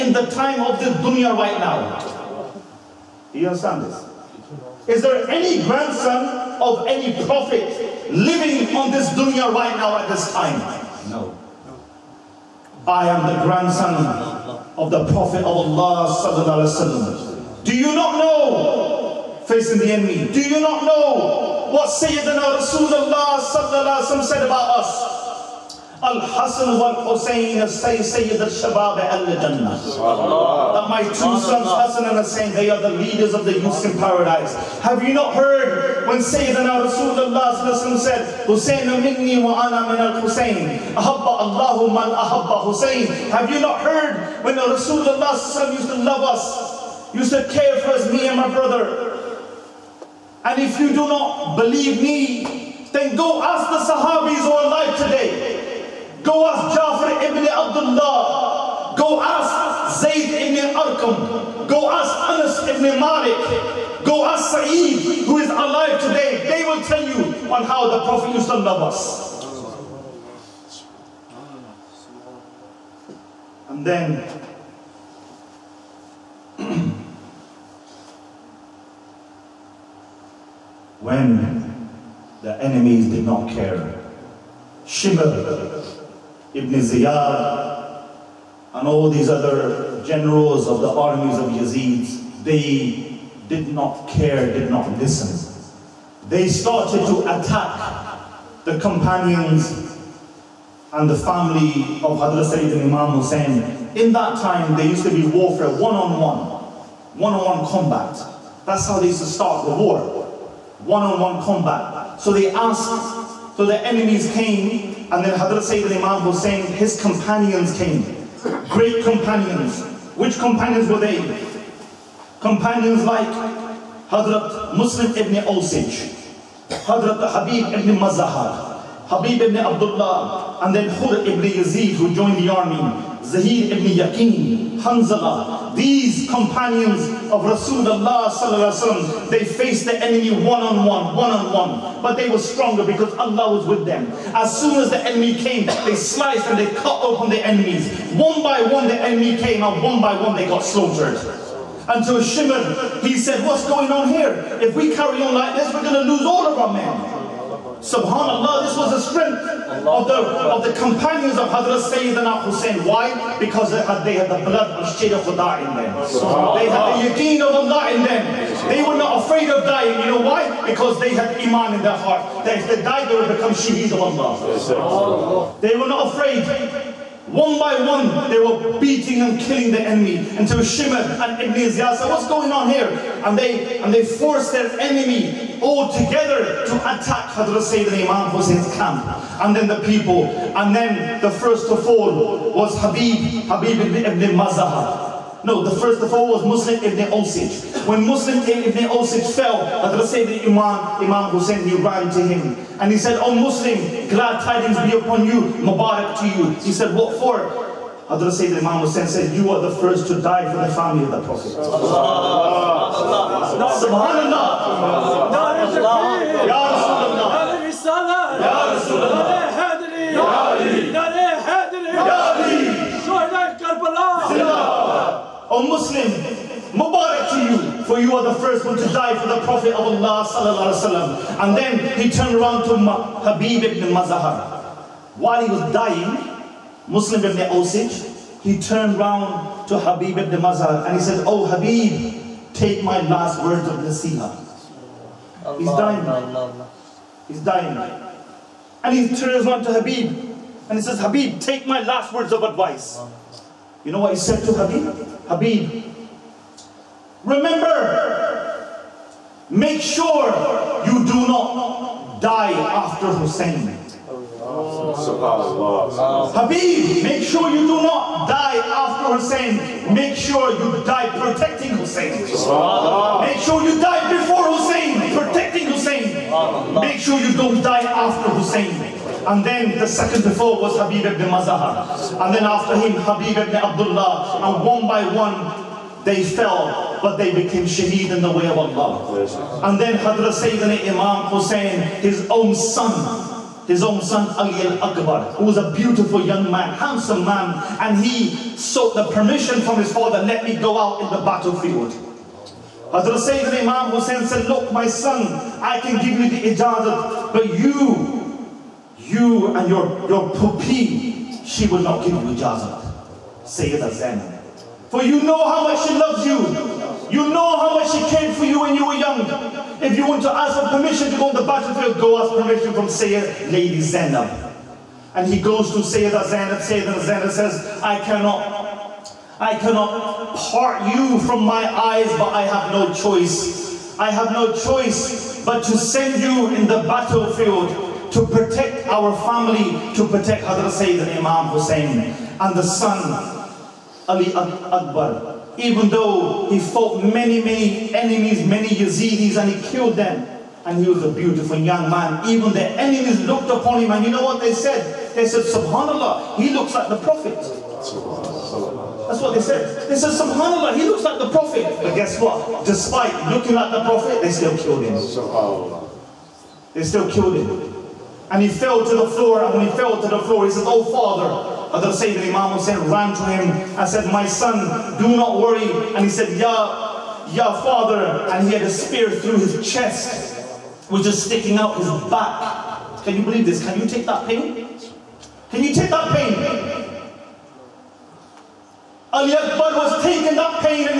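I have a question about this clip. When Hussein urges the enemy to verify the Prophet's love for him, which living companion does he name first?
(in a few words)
Jafar ibn Abdullah.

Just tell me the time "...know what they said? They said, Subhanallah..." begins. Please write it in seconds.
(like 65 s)
354 s.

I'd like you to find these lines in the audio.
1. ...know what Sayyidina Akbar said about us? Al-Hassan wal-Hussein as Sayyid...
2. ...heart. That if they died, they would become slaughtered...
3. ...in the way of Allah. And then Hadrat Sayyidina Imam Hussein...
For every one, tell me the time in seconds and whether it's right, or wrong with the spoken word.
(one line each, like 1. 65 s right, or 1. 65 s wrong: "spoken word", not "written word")
1. 20 s wrong: "Rasulullah", not "Akbar"
2. 171 s wrong: "shaheed", not "slaughtered"
3. 288 s right.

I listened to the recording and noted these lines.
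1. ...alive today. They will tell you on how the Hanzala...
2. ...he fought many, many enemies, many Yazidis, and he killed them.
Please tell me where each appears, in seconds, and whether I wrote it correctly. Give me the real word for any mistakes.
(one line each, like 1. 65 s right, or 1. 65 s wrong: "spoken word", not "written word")
1. 65 s wrong: "Prophet", not "Hanzala"
2. 346 s right.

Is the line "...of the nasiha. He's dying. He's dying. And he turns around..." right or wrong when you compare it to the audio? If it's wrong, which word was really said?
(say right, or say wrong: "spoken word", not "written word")
right.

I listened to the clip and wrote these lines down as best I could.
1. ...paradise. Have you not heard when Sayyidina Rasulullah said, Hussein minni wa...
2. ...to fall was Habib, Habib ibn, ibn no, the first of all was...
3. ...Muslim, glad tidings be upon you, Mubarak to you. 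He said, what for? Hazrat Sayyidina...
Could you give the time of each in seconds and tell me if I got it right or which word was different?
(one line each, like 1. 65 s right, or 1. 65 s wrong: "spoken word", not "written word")
1. 34 s right
2. 191 s right
3. 203 s right.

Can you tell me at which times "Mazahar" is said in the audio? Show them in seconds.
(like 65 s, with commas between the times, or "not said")
127 s, 233 s, 240 s, 281 s.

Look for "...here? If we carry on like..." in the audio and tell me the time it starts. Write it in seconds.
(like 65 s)
154 s.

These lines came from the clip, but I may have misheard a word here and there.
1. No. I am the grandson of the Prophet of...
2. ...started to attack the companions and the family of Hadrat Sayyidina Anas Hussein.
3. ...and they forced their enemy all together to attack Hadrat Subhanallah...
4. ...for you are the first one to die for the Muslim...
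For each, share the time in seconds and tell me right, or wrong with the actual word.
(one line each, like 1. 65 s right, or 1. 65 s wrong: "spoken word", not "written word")
1. 11 s right
2. 96 s wrong: "Imam", not "Anas"
3. 183 s wrong: "Sayyidina", not "Subhanallah"
4. 227 s wrong: "Prophet", not "Muslim".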